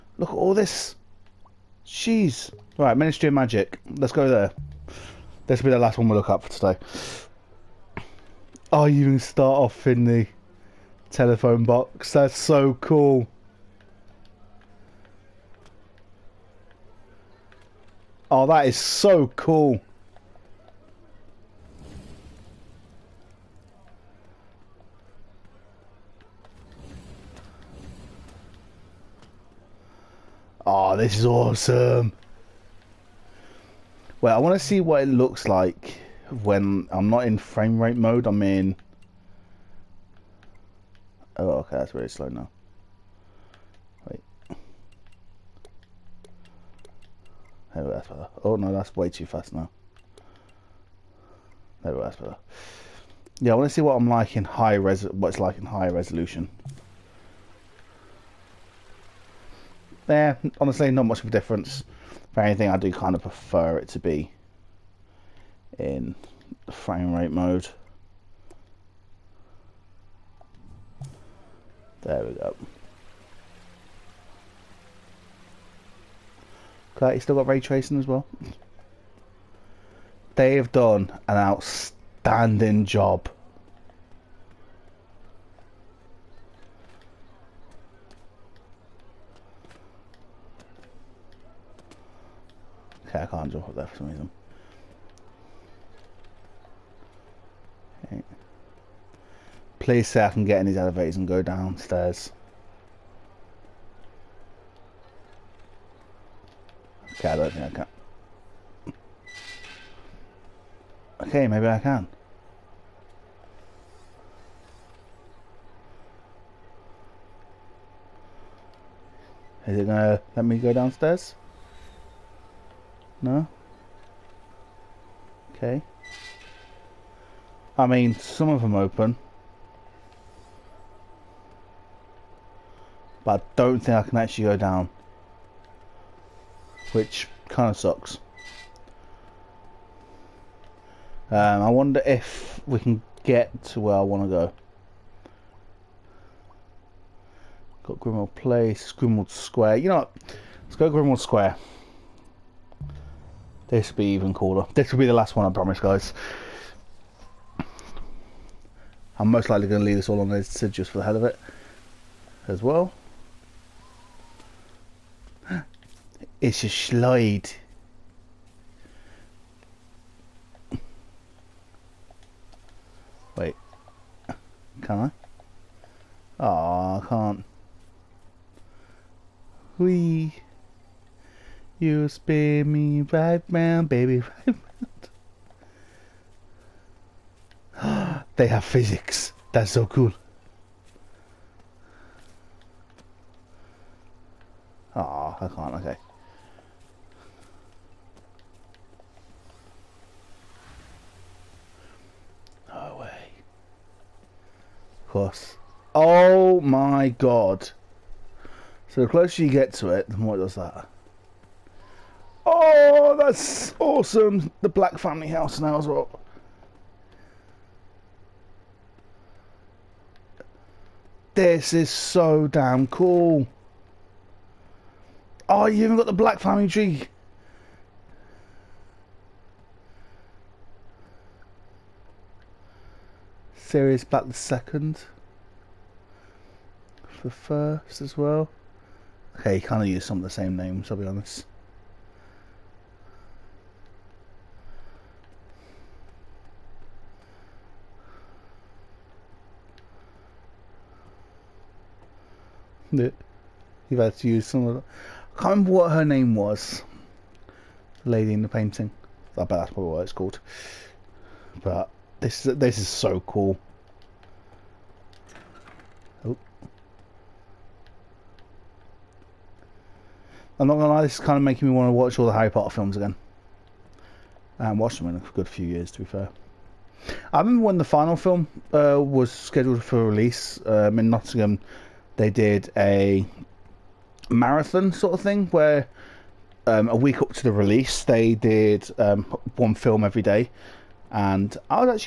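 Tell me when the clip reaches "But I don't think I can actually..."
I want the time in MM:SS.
02:13.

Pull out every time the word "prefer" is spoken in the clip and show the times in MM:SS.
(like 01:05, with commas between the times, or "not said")
01:03.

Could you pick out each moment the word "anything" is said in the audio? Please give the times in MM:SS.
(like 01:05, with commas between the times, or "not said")
01:02.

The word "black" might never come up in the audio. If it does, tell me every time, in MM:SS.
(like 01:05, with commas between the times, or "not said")
03:34, 03:46, 03:54.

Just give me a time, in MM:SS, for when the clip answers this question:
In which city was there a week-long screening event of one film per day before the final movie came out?
04:41.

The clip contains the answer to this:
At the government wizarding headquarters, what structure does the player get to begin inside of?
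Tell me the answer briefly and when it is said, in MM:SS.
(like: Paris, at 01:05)
The telephone box, at 00:11.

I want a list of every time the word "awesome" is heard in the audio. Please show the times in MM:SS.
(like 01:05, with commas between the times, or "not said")
00:31, 03:33.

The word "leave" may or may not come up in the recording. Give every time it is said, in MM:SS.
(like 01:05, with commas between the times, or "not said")
02:39.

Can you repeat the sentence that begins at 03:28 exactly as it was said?
So the closer you get to it, the more it does that.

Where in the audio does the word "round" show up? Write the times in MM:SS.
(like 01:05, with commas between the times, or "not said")
03:03, 03:07.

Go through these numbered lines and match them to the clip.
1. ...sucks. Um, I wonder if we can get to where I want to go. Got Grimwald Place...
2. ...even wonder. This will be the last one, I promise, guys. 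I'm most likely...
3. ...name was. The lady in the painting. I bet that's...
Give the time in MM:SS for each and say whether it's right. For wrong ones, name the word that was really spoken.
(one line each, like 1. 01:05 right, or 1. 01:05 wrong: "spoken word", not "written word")
1. 02:17 right
2. 02:34 wrong: "cooler", not "wonder"
3. 04:16 right.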